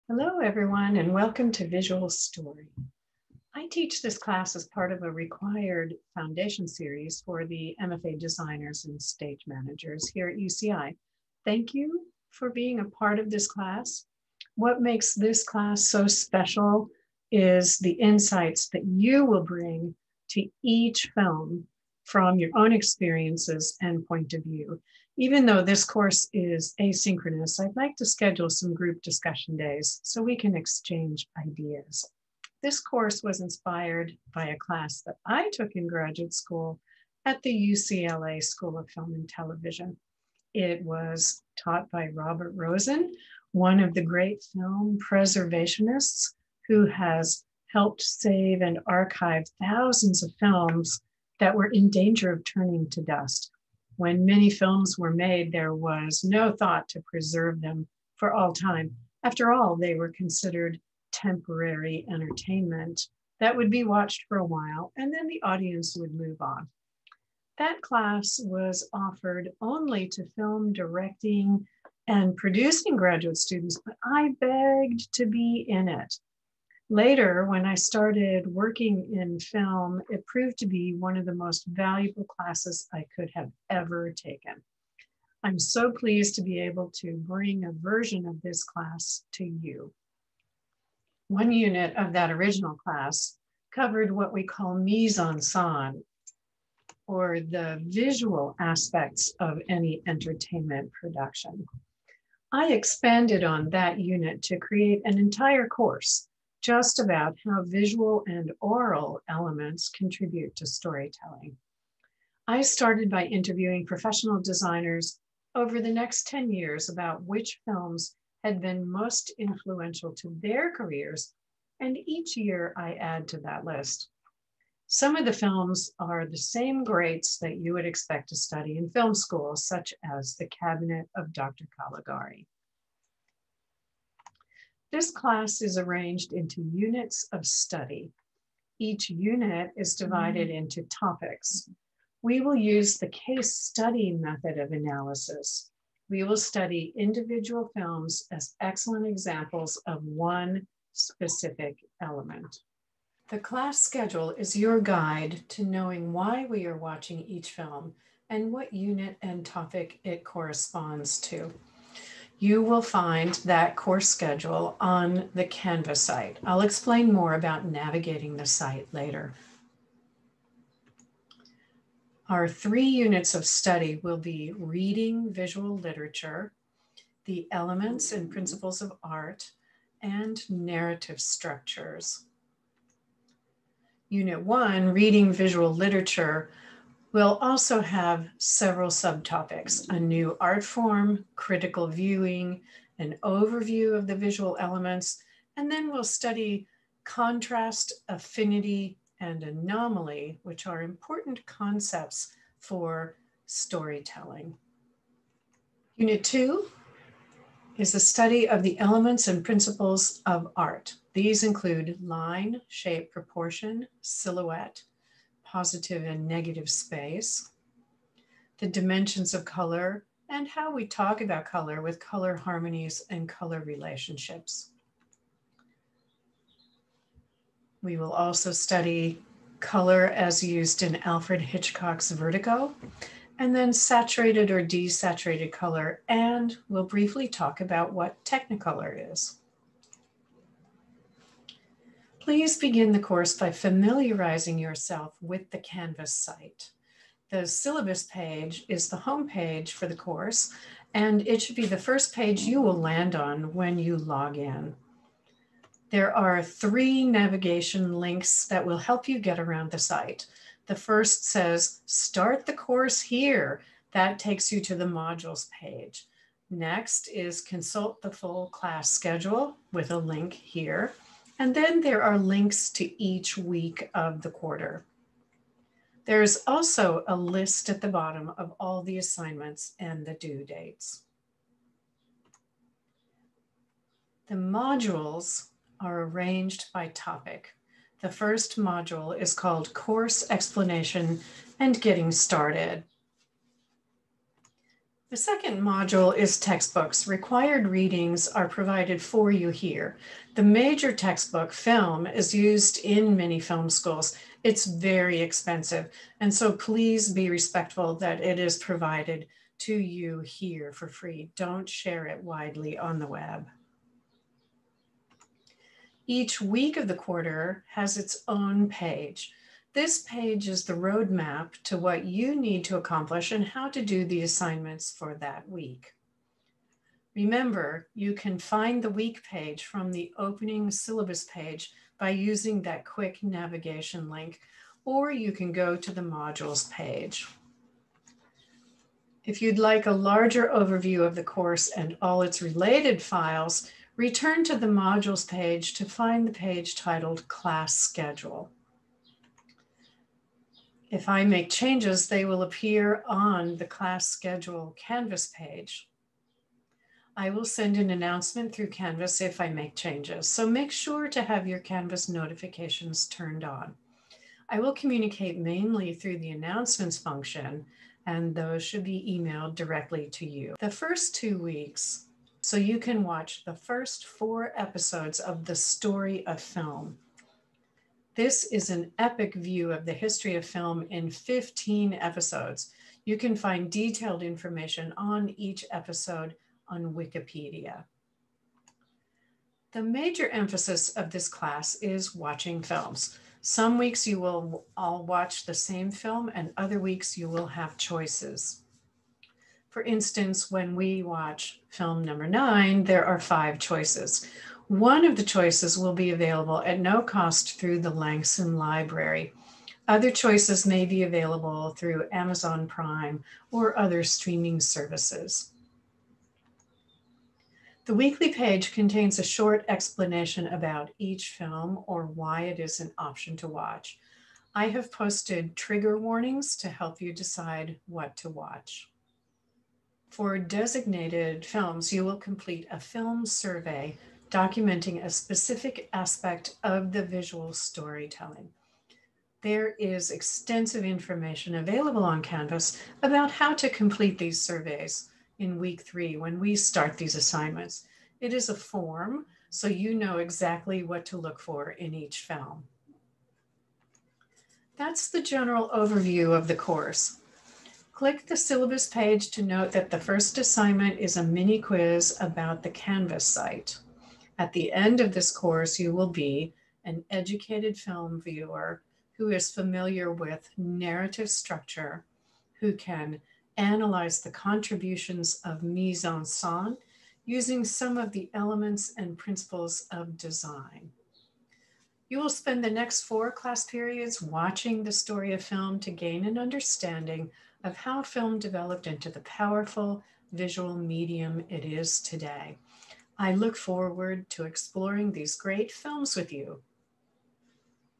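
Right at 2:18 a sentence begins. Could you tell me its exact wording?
Each unit is divided mm -hmm.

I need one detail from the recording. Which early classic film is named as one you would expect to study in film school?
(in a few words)
The Cabinet of Dr. Caligari.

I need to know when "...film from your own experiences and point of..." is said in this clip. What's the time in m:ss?
0:21.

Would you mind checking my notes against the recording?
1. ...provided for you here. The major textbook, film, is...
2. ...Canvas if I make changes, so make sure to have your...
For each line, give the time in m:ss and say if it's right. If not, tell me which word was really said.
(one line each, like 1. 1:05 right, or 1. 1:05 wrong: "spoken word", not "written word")
1. 4:58 right
2. 5:58 right.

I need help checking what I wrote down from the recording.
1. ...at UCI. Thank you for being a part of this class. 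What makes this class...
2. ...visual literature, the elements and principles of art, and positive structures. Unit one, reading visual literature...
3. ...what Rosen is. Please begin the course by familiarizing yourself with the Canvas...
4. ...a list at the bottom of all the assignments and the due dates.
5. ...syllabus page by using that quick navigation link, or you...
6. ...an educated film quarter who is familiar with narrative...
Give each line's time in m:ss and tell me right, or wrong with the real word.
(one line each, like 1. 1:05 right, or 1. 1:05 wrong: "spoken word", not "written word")
1. 0:10 right
2. 2:55 wrong: "narrative", not "positive"
3. 3:57 wrong: "Technicolor", not "Rosen"
4. 4:37 right
5. 5:30 right
6. 7:46 wrong: "viewer", not "quarter".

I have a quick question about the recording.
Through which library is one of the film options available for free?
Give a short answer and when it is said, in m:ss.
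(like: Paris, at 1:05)
Langson Library, at 6:47.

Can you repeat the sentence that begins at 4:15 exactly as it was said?
There are three navigation links that will help you get around the site.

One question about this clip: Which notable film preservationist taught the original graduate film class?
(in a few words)
Robert Rosen.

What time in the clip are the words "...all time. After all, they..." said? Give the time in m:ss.
0:58.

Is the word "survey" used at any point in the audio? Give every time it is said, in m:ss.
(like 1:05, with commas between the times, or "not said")
7:13, 7:24.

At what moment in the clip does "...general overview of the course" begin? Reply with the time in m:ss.
7:35.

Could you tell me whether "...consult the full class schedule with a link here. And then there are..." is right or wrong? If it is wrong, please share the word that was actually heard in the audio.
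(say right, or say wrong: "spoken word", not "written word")
right.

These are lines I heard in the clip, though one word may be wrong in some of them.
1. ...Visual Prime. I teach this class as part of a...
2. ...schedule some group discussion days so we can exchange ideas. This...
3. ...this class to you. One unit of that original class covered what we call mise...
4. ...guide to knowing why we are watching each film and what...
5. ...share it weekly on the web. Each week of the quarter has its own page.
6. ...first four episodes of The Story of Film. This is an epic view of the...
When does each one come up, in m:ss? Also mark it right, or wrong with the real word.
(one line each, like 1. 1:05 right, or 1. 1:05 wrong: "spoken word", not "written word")
1. 0:01 wrong: "Story", not "Prime"
2. 0:28 right
3. 1:28 right
4. 2:34 right
5. 5:11 wrong: "widely", not "weekly"
6. 6:13 right.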